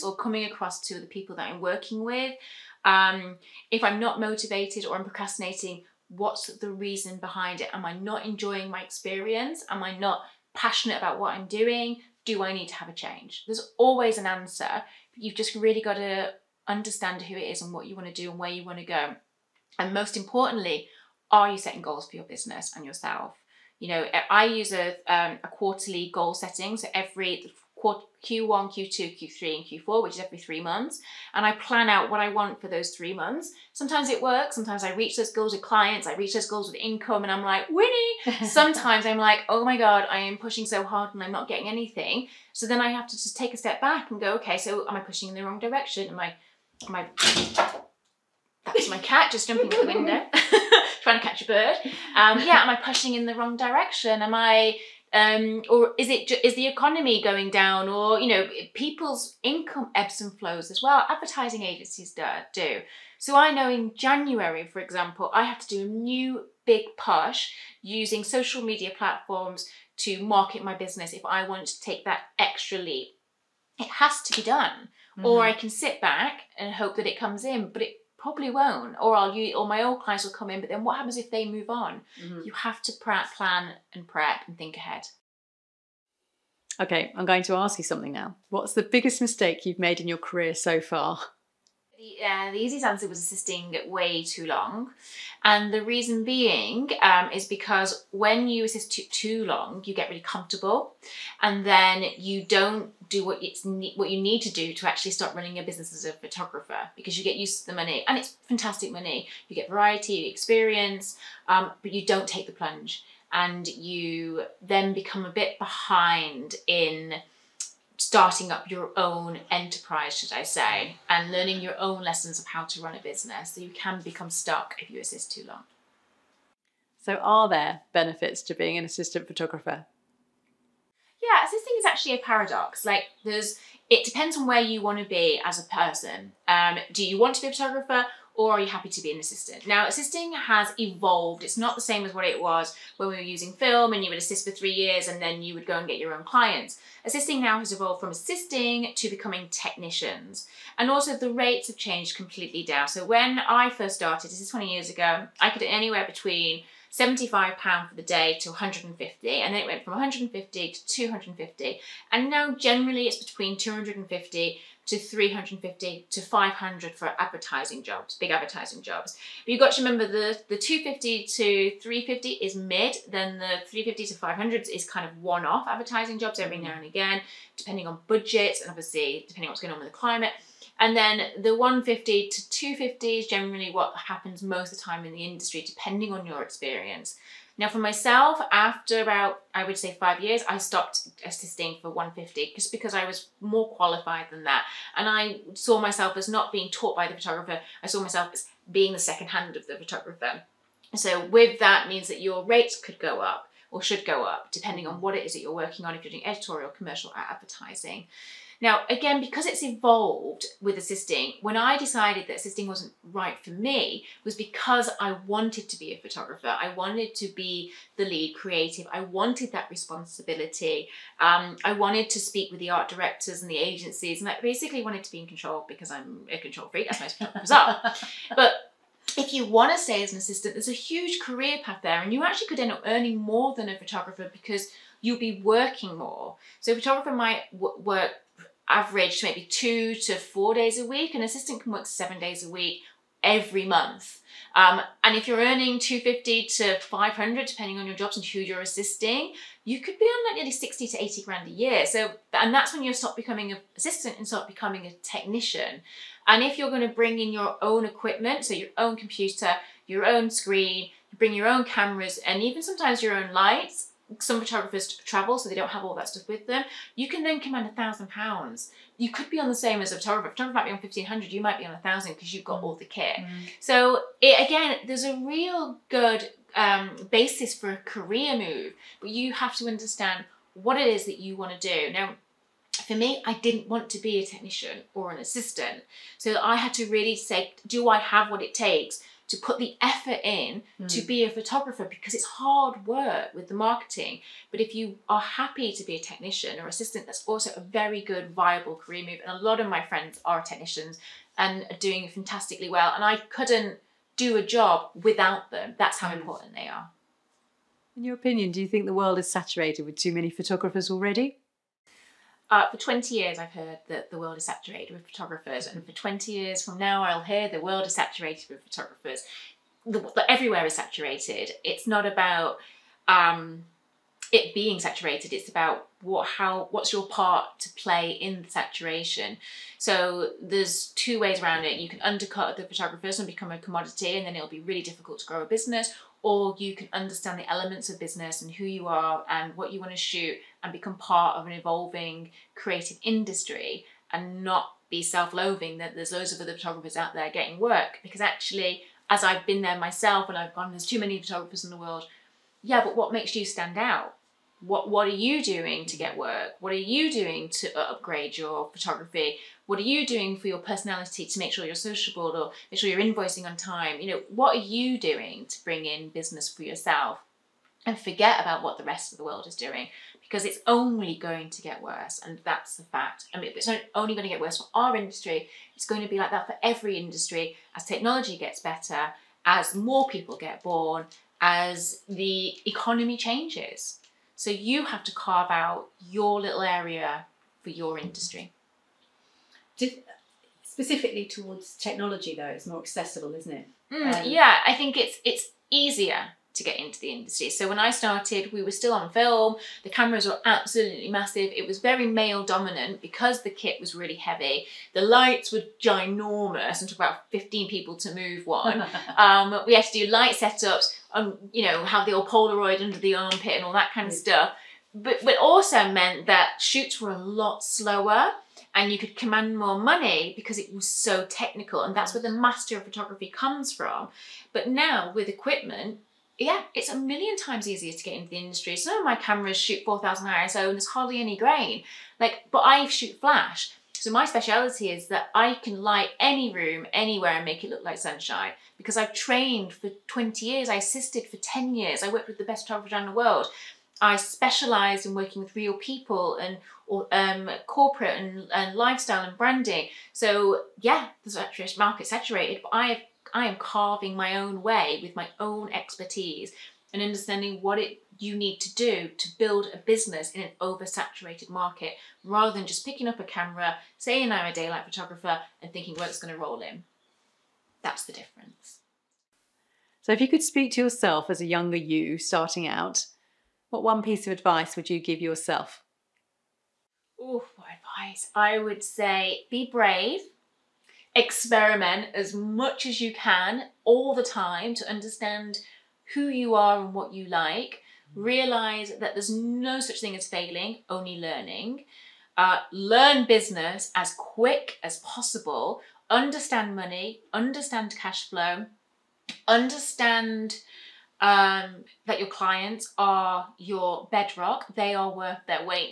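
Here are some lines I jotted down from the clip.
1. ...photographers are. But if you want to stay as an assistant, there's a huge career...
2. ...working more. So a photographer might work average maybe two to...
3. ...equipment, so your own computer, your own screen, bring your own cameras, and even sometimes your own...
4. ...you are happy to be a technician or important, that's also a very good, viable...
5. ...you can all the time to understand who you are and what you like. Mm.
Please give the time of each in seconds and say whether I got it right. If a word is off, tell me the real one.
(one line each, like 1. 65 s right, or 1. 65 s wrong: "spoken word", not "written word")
1. 227 s right
2. 235 s right
3. 257 s right
4. 294 s wrong: "assistant", not "important"
5. 482 s right.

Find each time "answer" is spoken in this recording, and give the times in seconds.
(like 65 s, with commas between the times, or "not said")
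14 s, 92 s.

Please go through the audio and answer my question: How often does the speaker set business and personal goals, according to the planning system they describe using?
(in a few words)
Every three months.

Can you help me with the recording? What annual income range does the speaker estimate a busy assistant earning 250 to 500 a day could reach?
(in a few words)
60 to 80 grand.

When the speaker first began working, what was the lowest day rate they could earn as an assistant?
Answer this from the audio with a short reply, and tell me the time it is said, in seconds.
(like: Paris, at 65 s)
£75, at 156 s.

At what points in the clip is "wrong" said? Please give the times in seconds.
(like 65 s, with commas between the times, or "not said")
45 s, 53 s.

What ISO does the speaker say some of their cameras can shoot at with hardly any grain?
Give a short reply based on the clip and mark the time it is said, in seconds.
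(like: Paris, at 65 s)
4000 ISO, at 429 s.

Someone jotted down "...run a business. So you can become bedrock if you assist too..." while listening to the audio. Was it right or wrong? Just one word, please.
wrong.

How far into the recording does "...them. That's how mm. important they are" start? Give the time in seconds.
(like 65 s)
305 s.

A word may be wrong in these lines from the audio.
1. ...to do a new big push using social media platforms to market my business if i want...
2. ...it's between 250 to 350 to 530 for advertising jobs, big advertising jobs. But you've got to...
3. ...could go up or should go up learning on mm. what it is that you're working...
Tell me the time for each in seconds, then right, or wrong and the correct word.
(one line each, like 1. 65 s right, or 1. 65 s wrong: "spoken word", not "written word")
1. 65 s right
2. 163 s wrong: "500", not "530"
3. 202 s wrong: "depending", not "learning".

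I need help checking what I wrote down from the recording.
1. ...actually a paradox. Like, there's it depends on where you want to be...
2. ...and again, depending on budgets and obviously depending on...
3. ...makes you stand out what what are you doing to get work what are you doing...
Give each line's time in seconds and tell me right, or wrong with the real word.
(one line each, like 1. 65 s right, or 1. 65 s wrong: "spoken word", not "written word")
1. 131 s right
2. 176 s right
3. 353 s right.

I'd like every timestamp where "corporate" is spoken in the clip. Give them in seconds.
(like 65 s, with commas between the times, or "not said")
447 s.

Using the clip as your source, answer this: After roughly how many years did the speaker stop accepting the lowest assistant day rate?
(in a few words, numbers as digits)
5 years.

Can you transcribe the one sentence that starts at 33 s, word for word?
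Sometimes it works, sometimes I reach those goals with clients, I reach those goals with income, and I'm like, Winnie!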